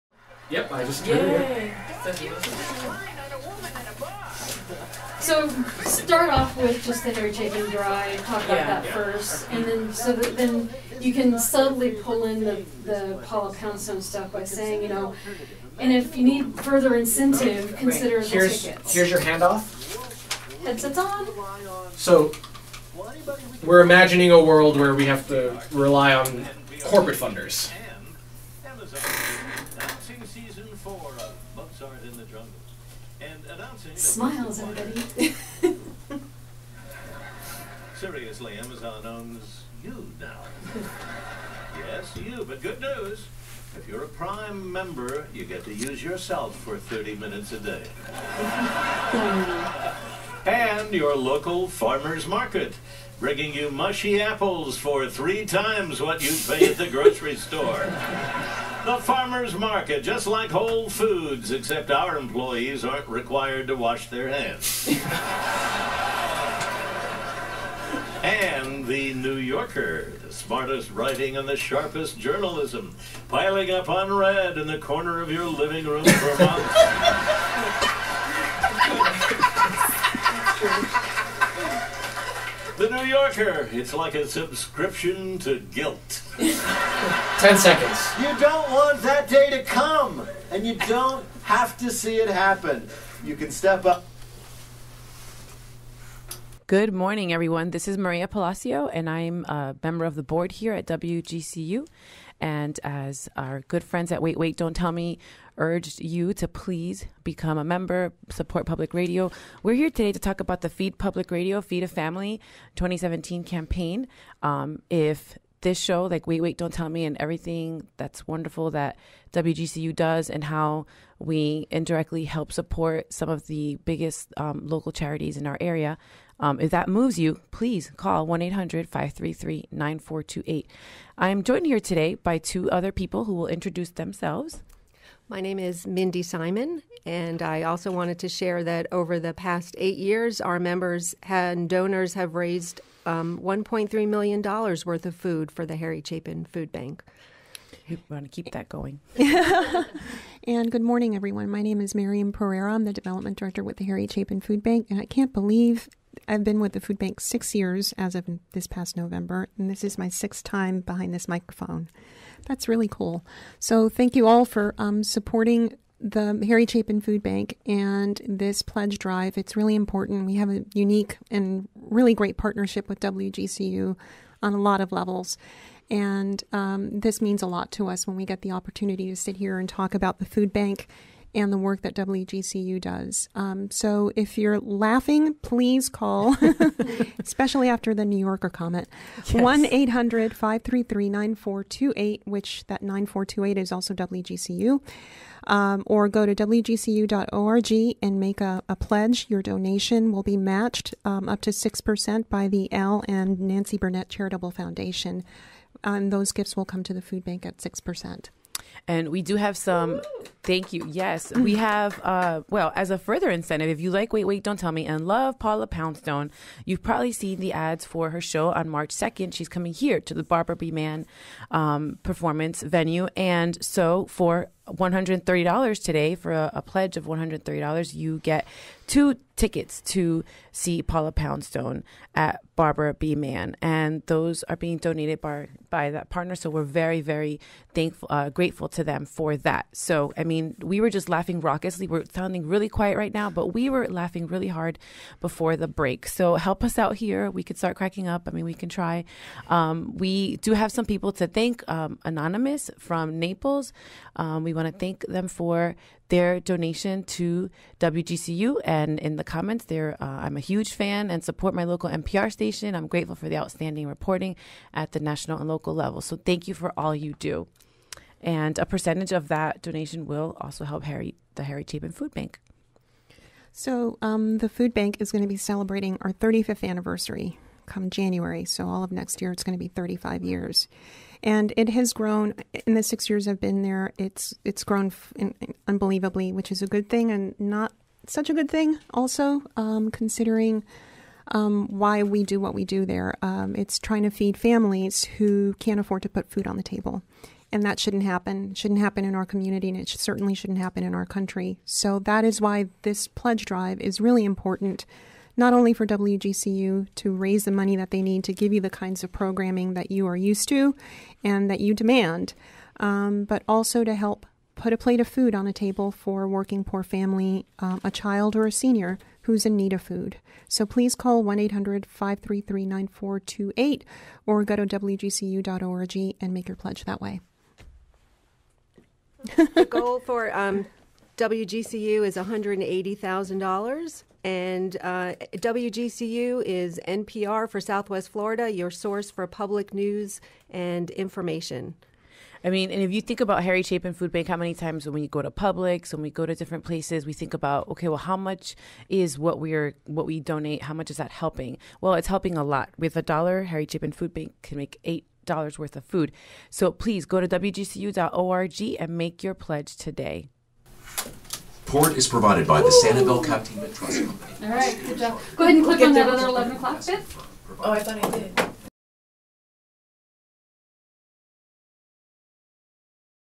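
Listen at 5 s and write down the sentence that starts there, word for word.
So start off with just the hair taken dry, talk about yeah, that yeah.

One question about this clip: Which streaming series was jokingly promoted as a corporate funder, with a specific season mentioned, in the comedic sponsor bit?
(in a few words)
Mozart in the Jungle.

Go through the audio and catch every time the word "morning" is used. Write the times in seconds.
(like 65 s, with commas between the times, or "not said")
96 s, 150 s.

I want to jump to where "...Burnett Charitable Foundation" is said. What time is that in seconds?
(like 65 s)
203 s.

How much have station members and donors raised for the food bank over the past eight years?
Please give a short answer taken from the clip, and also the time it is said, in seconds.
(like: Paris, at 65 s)
$1.3 million, at 143 s.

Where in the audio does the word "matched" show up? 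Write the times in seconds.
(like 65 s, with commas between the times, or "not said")
200 s.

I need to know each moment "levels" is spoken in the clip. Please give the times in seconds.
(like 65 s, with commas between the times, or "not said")
174 s, 265 s.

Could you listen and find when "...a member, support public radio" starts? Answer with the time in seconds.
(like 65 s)
107 s.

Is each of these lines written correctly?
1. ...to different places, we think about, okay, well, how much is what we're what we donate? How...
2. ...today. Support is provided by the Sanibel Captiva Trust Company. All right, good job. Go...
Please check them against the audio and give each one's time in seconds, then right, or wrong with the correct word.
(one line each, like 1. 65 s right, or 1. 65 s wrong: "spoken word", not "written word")
1. 346 s right
2. 359 s right.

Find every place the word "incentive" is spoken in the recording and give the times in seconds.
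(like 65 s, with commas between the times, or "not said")
16 s, 213 s.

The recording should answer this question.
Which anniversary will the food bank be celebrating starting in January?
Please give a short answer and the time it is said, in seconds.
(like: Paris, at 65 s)
35th, at 276 s.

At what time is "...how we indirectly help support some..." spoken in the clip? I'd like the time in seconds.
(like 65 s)
120 s.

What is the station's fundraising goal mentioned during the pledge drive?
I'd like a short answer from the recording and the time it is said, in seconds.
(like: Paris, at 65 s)
$180,000, at 332 s.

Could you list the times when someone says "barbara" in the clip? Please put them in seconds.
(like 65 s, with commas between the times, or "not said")
220 s, 232 s.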